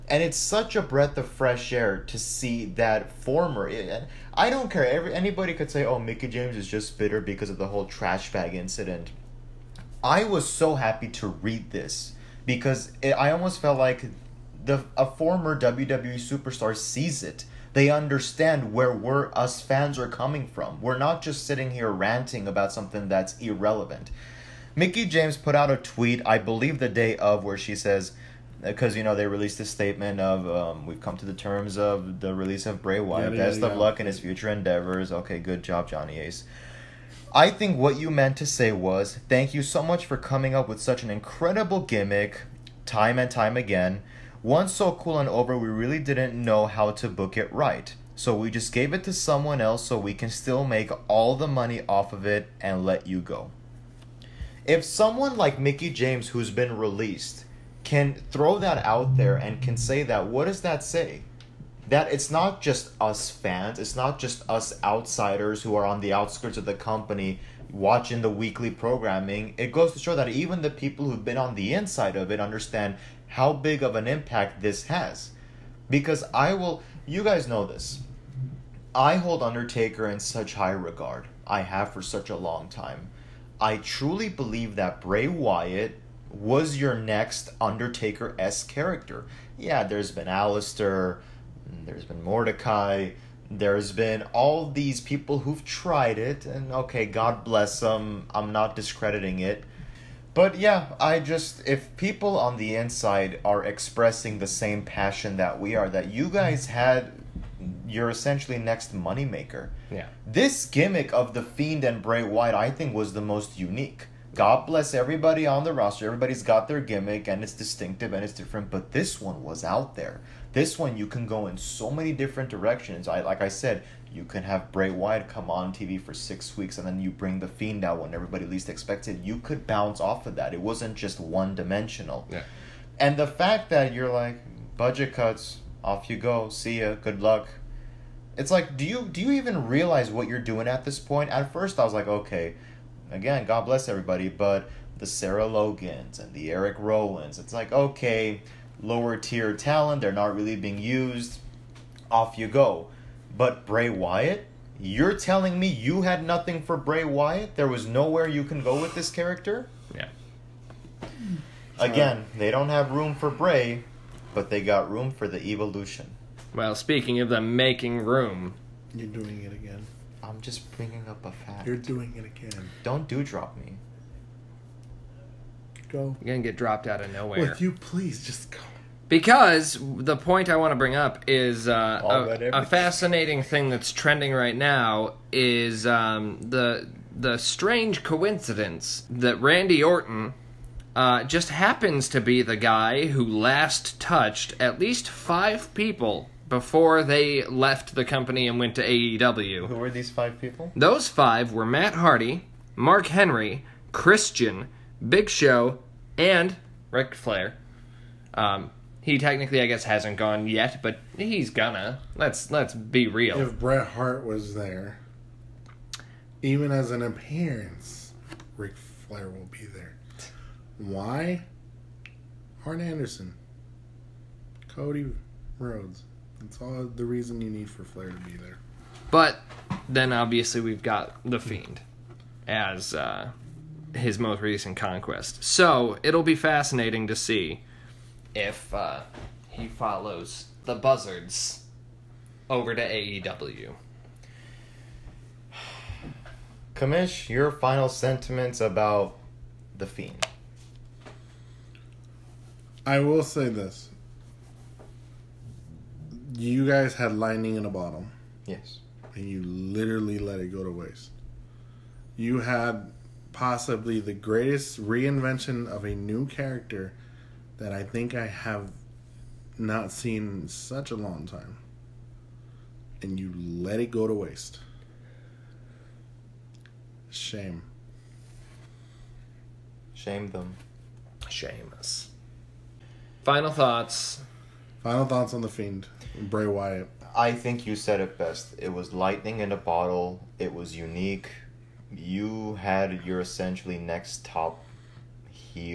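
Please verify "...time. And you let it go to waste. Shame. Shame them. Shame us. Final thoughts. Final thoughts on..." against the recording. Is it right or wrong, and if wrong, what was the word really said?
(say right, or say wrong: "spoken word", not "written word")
right.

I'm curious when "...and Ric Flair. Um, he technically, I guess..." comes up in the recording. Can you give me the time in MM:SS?
03:26.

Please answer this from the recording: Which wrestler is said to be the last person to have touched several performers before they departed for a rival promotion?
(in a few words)
Randy Orton.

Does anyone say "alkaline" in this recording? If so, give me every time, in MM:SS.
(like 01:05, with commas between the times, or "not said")
not said.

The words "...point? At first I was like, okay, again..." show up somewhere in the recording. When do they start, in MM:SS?
02:20.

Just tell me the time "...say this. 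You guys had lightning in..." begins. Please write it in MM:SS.
04:13.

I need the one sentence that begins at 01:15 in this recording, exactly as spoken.
Because I will, you guys know this.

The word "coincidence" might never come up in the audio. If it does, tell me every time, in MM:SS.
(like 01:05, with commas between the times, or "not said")
03:08.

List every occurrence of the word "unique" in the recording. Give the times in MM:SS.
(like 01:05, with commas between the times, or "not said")
01:53, 04:50.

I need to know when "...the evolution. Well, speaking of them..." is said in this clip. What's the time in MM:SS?
02:45.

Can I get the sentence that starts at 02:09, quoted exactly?
You could bounce off of that.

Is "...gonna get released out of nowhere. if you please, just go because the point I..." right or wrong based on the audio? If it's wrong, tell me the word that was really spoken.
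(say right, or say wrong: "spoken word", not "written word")
wrong: "dropped", not "released".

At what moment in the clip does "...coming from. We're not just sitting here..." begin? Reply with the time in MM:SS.
00:20.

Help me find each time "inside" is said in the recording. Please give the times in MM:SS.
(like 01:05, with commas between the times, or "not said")
01:11, 01:42.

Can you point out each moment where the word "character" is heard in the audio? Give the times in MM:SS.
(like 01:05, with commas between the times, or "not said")
01:28, 02:39, 04:26.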